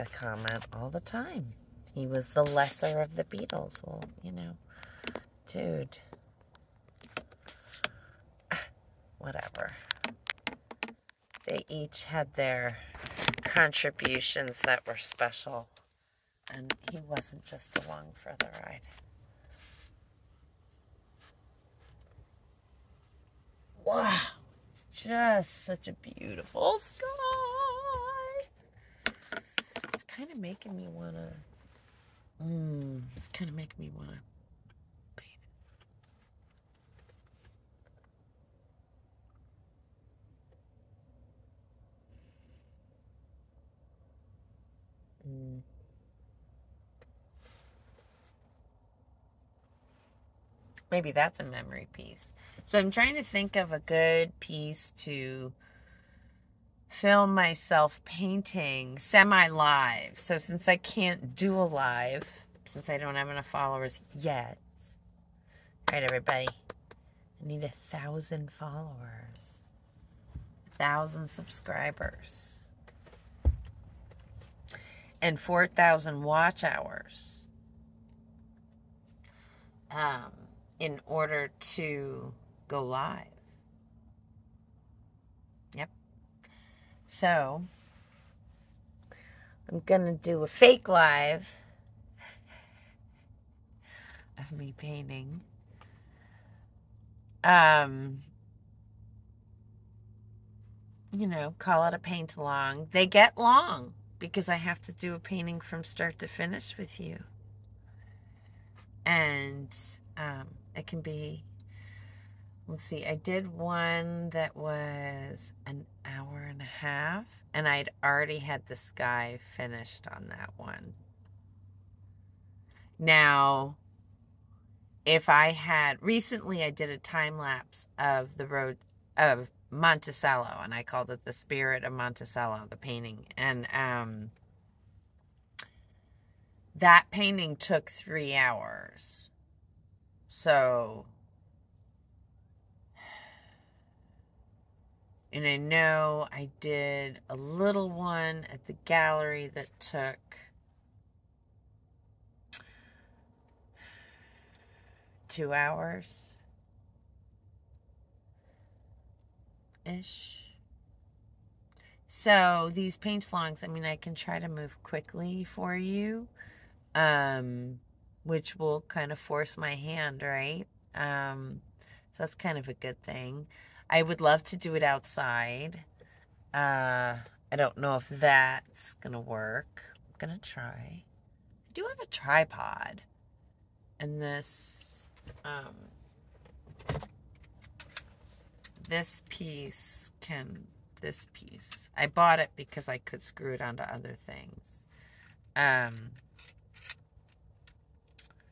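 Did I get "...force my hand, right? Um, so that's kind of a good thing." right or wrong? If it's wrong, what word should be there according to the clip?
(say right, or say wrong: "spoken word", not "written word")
right.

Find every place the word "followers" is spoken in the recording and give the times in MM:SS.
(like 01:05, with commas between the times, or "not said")
01:03, 01:08.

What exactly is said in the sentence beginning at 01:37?
Um, you know, call it a paint along.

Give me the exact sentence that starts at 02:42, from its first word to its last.
So these paint longs, I mean, I can try to move quickly for you.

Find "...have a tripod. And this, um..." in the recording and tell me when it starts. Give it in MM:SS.
03:01.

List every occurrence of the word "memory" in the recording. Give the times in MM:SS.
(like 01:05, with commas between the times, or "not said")
00:51.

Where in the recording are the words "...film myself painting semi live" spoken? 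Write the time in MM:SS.
00:56.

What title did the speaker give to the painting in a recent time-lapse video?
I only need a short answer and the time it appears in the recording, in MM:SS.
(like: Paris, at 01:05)
The Spirit of Monticello, at 02:11.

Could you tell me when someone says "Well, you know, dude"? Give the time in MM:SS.
00:03.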